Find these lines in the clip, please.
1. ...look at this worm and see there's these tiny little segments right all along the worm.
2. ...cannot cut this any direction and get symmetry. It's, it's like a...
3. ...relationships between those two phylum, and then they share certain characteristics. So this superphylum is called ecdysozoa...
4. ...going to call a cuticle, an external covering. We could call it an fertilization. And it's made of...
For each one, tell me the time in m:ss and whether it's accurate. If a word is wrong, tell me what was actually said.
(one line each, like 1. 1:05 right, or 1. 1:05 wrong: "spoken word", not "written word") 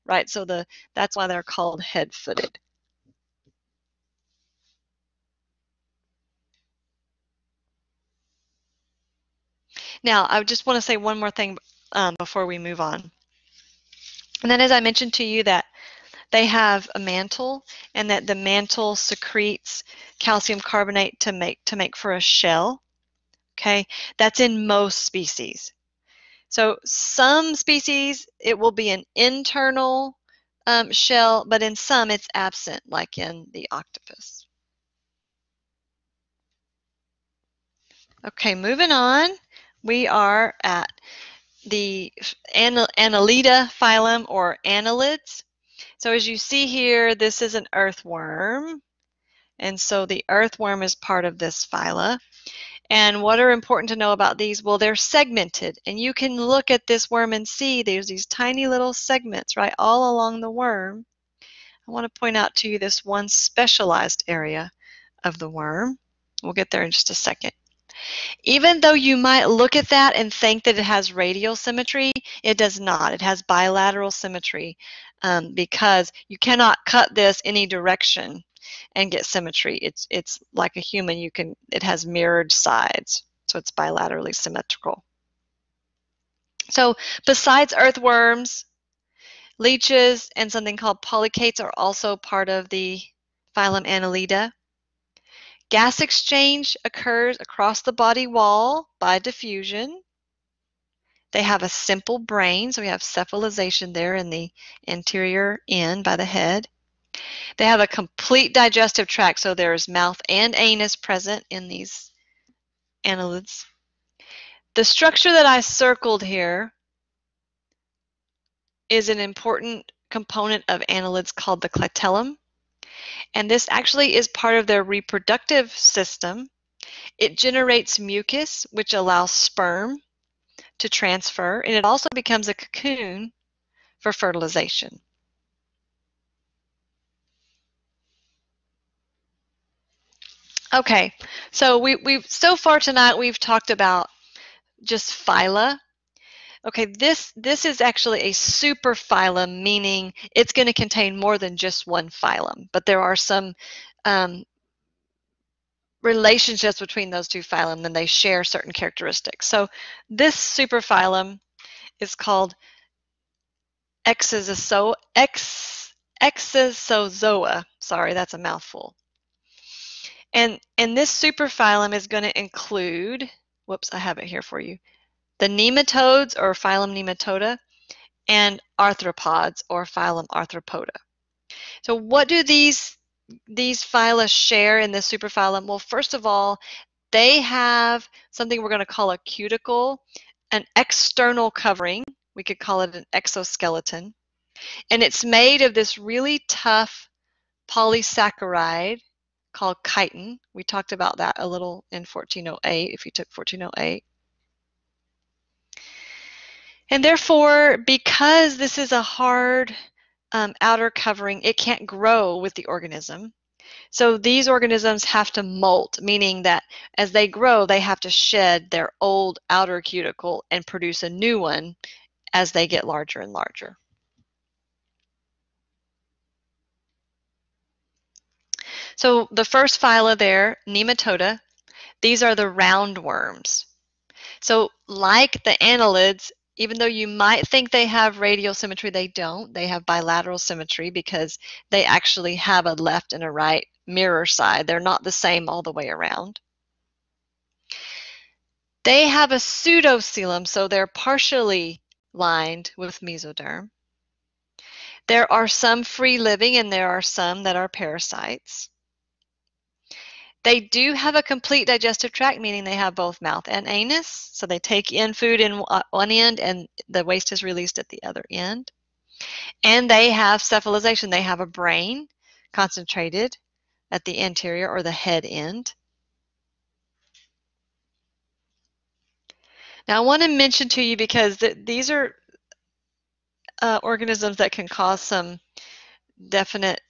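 1. 0:56 right
2. 1:16 right
3. 2:36 right
4. 3:08 wrong: "exoskeleton", not "fertilization".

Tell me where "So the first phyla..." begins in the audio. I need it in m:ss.
3:48.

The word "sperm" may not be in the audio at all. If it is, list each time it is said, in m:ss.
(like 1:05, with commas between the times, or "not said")
2:09.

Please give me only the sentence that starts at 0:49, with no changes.
And so the earthworm is part of this phyla.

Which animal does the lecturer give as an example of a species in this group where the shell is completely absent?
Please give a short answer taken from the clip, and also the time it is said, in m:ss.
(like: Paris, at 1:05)
Octopus, at 0:33.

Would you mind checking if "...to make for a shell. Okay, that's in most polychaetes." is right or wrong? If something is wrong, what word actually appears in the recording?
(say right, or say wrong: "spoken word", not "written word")
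wrong: "species", not "polychaetes".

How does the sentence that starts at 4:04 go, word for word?
They're not the same all the way around.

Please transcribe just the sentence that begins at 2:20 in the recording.
Okay, so we, we've so far tonight we've talked about just phyla.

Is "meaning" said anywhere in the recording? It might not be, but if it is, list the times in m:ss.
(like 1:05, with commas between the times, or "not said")
2:29, 3:36, 4:22.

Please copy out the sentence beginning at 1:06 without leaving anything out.
We'll get there in just a second.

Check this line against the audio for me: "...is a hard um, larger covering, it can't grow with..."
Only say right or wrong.
wrong.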